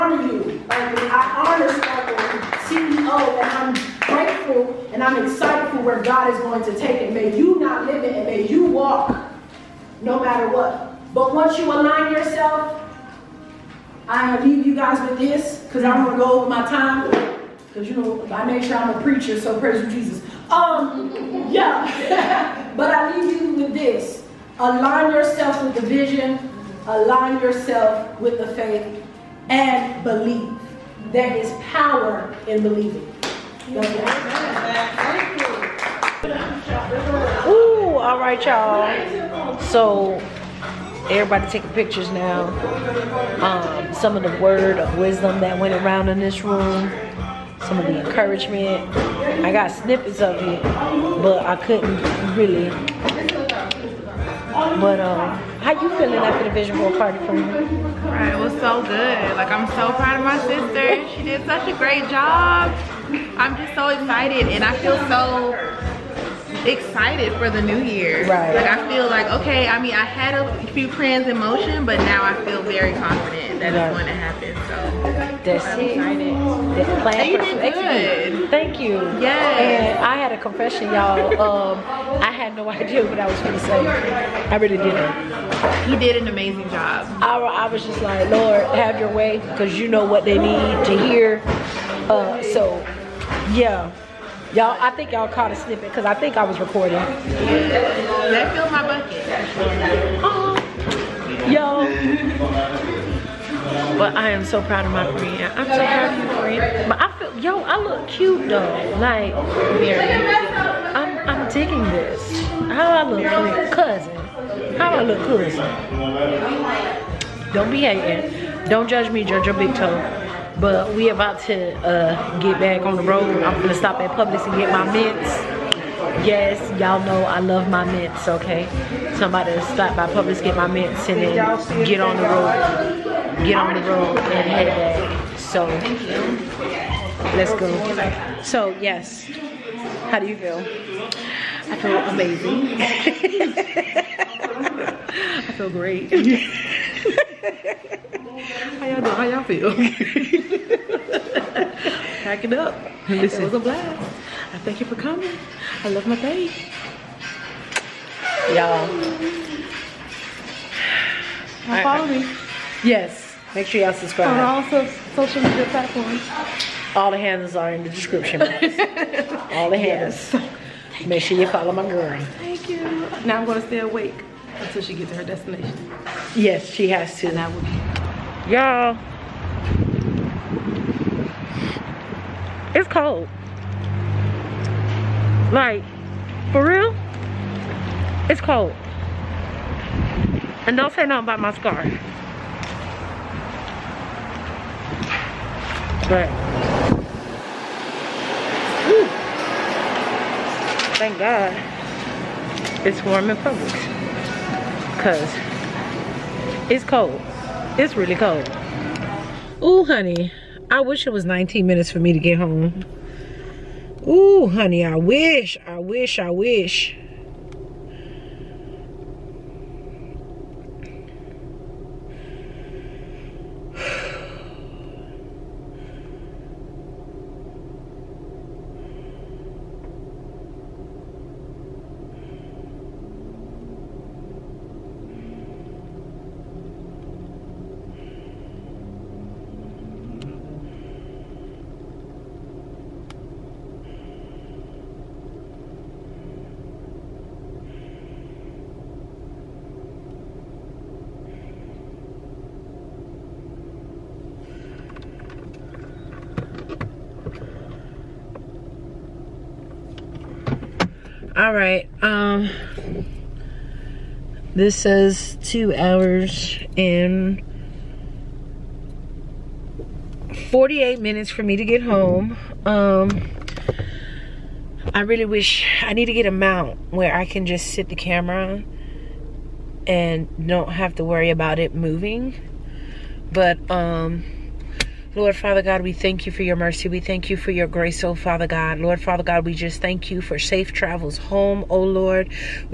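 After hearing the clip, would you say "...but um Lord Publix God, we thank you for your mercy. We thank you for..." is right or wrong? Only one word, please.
wrong.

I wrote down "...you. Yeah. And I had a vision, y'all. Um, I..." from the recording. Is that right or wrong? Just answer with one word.
wrong.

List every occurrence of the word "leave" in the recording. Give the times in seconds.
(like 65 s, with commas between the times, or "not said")
14 s, 23 s.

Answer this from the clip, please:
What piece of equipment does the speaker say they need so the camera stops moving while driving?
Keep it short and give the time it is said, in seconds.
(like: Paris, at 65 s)
A mount, at 276 s.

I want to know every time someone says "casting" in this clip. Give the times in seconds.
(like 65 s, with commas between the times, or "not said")
not said.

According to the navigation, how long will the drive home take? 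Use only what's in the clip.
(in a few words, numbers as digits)
2 hours 48 minutes.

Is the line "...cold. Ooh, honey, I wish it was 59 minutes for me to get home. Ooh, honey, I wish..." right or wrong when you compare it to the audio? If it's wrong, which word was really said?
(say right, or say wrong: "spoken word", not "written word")
wrong: "19", not "59".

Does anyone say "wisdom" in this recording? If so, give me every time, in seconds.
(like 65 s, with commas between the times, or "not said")
44 s.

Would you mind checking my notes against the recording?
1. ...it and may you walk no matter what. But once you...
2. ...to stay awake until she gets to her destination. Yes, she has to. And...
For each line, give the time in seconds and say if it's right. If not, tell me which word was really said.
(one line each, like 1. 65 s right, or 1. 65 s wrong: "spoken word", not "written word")
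1. 8 s right
2. 173 s right.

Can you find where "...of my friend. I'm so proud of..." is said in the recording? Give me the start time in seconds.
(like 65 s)
104 s.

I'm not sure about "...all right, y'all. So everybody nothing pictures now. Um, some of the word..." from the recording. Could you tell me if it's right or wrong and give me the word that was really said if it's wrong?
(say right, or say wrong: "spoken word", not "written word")
wrong: "taking", not "nothing".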